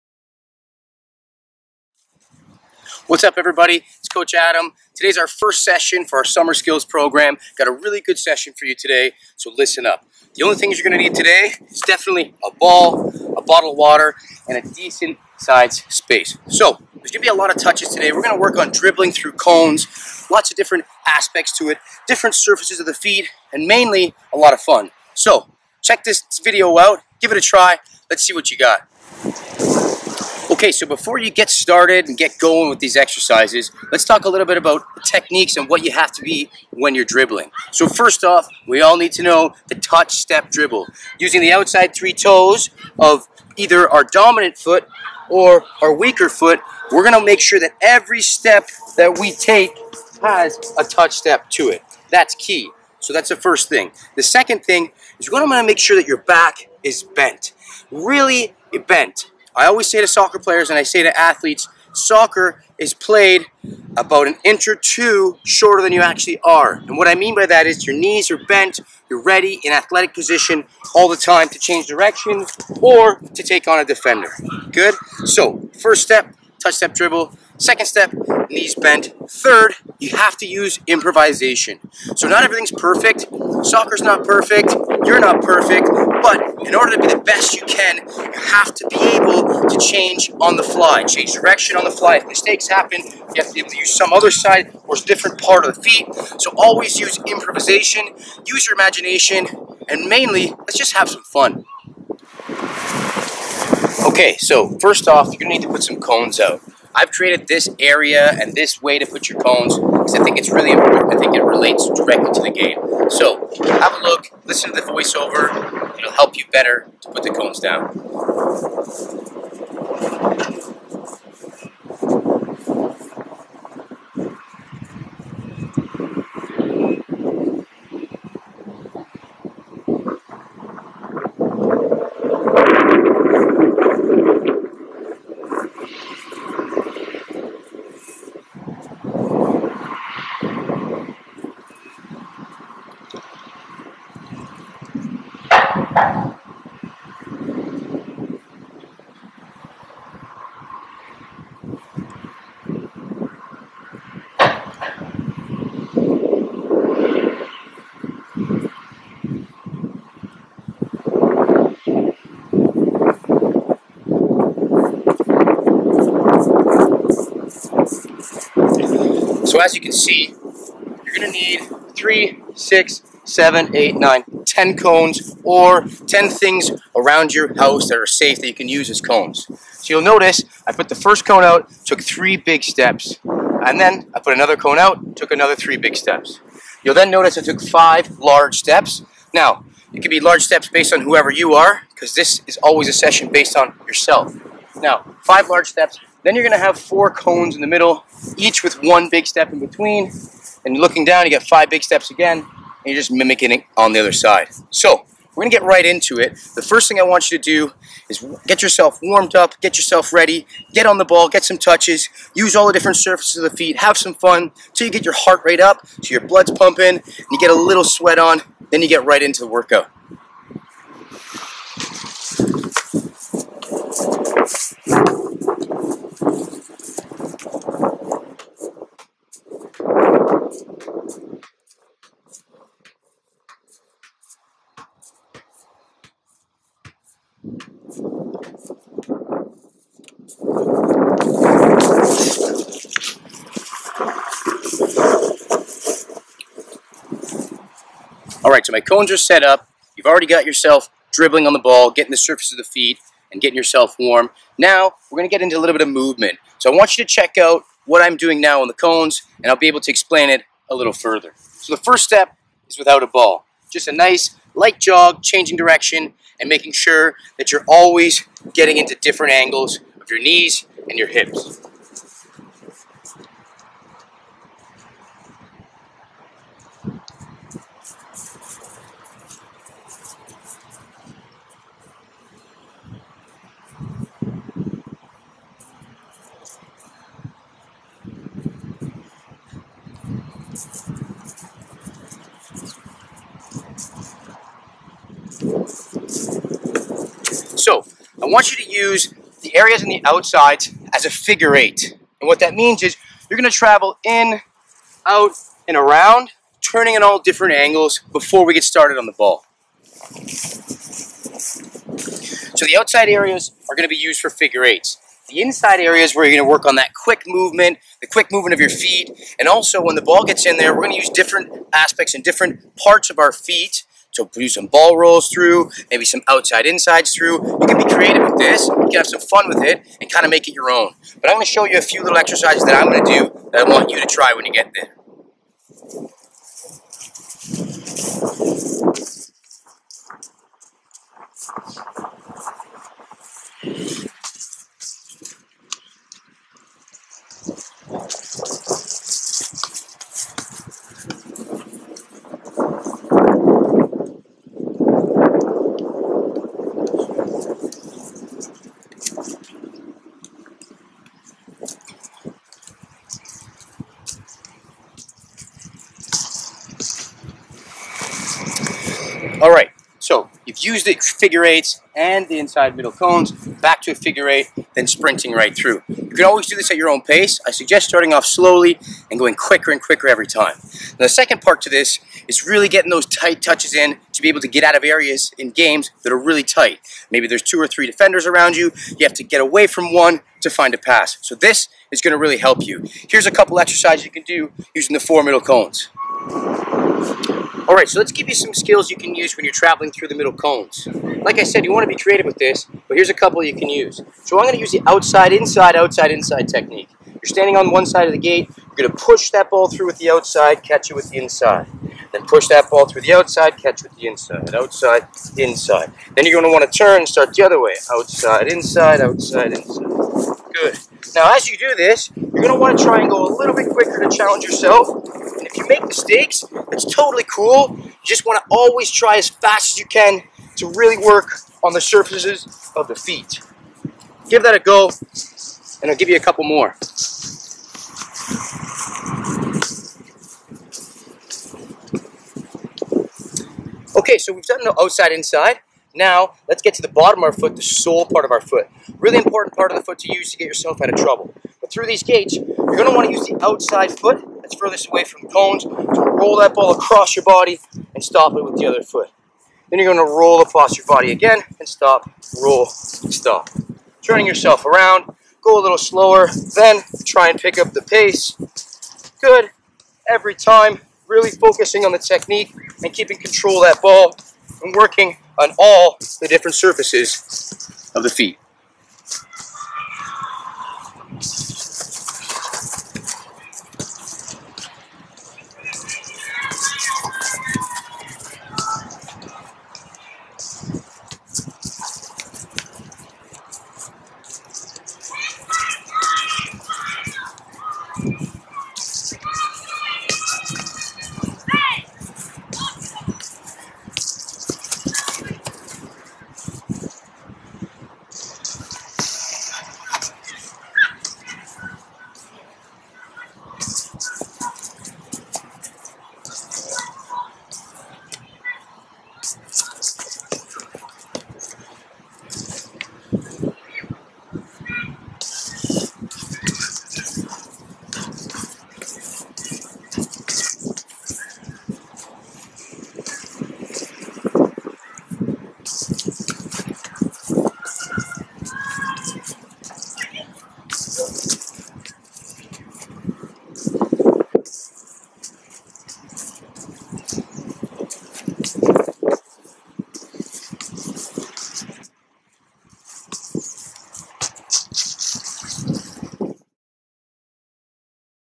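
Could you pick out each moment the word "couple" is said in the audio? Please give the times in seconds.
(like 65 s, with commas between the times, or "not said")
393 s, 403 s, 436 s.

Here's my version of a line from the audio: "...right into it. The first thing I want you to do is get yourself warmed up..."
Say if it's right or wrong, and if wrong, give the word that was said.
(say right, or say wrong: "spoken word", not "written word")
right.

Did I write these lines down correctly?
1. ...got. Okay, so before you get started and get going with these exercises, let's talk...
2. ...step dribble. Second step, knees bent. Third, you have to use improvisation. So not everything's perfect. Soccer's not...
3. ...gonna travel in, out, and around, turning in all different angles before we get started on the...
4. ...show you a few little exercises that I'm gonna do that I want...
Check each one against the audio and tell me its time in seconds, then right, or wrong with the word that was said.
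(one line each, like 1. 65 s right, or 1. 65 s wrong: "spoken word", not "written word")
1. 28 s right
2. 76 s right
3. 303 s right
4. 331 s right.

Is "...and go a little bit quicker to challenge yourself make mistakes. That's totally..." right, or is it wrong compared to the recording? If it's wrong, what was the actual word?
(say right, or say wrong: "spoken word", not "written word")
right.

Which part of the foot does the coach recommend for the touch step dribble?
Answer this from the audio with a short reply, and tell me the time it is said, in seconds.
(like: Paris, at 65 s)
outside three toes, at 41 s.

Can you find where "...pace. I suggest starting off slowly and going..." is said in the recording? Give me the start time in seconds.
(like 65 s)
377 s.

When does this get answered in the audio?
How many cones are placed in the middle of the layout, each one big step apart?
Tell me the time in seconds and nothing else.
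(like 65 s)
196 s.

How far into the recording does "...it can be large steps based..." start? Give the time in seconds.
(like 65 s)
189 s.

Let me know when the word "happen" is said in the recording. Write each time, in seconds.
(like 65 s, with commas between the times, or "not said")
92 s.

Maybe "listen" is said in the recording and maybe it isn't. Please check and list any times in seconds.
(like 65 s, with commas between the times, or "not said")
9 s, 114 s.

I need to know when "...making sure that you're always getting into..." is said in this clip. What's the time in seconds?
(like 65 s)
266 s.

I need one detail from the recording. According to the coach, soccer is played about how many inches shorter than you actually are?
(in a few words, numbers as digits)
1 or 2 inches.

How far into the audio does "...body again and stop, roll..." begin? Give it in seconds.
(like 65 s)
460 s.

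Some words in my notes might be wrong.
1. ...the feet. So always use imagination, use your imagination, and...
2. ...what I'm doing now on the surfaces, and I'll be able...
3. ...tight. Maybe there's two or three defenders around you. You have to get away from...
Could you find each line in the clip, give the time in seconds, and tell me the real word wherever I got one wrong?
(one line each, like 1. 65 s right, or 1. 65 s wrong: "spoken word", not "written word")
1. 95 s wrong: "improvisation", not "imagination"
2. 257 s wrong: "cones", not "surfaces"
3. 386 s right.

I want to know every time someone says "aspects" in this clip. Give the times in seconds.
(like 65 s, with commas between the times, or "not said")
21 s, 321 s.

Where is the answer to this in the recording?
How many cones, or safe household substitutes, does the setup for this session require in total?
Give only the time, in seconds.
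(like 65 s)
176 s.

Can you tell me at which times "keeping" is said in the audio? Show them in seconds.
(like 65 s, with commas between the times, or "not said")
472 s.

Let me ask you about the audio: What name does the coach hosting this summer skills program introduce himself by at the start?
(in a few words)
Coach Adam.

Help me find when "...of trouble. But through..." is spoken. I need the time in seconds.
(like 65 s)
450 s.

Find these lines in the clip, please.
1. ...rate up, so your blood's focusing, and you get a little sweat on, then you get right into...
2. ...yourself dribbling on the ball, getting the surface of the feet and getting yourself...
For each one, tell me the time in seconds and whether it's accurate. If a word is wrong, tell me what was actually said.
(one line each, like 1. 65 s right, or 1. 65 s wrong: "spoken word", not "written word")
1. 215 s wrong: "pumping", not "focusing"
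2. 250 s right.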